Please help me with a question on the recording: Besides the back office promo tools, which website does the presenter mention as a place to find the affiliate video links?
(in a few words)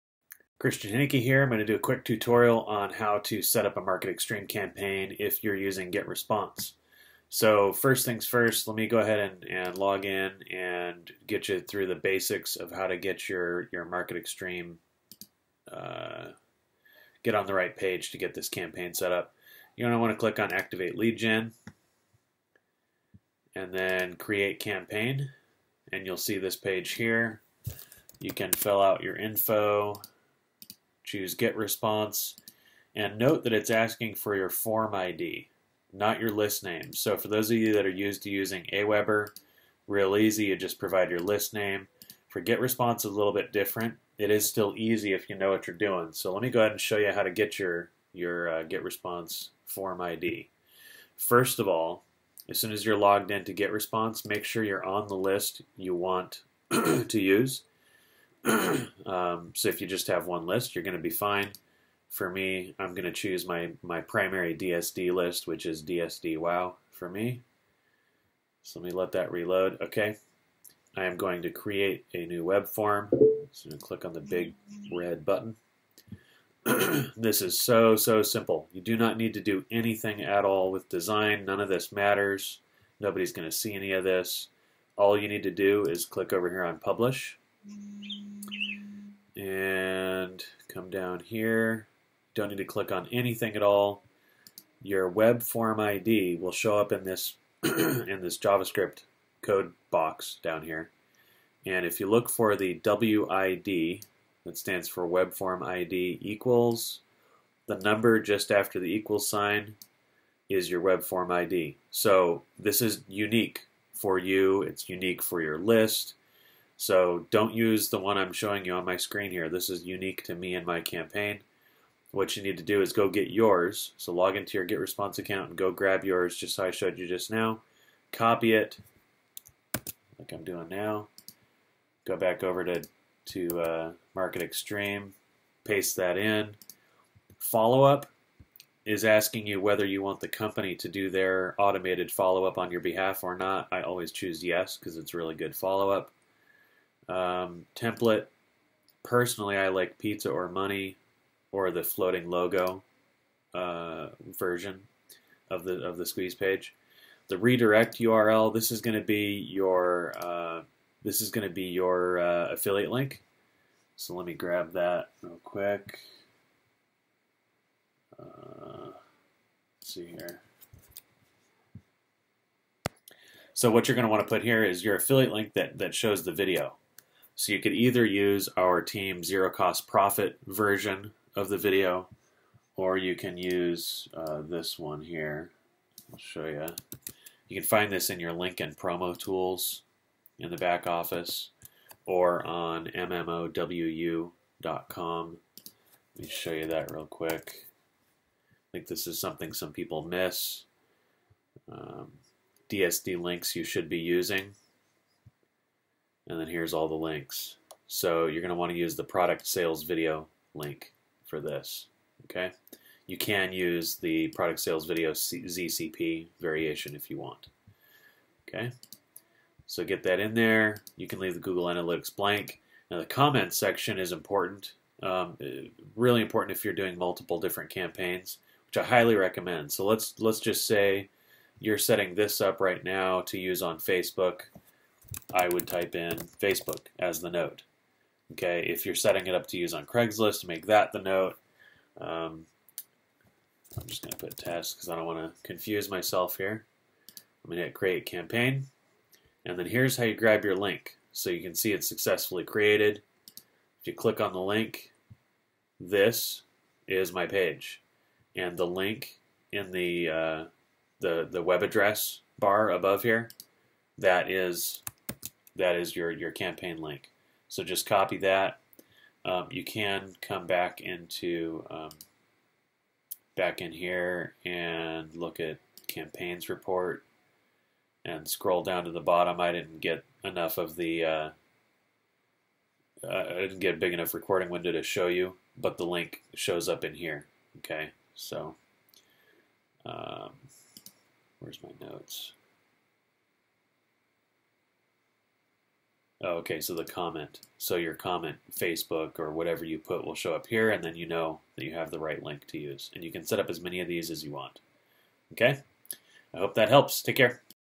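mmowu.com.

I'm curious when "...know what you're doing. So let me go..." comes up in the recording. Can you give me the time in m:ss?
0:45.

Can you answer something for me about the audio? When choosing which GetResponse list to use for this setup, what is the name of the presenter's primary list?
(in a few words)
DSD WoW.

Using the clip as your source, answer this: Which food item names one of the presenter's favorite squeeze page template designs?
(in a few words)
pizza.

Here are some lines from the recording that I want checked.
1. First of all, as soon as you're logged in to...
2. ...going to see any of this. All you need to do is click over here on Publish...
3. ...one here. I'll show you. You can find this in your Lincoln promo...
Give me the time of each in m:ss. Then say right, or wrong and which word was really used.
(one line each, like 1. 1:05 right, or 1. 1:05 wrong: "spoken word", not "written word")
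1. 0:51 right
2. 1:23 right
3. 3:04 right.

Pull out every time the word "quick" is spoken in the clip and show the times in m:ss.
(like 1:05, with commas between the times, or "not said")
0:01, 2:45, 3:17.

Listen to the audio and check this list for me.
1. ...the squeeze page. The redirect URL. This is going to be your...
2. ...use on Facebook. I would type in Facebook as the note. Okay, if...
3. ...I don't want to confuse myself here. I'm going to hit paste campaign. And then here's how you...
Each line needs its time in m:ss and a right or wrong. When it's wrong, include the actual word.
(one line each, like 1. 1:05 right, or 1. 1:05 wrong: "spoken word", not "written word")
1. 2:35 right
2. 3:53 right
3. 4:04 wrong: "create", not "paste".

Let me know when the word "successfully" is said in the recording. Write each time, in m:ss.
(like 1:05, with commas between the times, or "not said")
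4:11.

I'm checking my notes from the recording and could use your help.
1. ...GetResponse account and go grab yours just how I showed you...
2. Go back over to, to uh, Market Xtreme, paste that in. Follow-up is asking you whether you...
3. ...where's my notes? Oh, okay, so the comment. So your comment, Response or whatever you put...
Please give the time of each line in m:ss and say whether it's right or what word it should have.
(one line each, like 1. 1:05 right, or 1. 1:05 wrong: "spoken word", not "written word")
1. 2:04 right
2. 2:12 right
3. 4:51 wrong: "Facebook", not "Response".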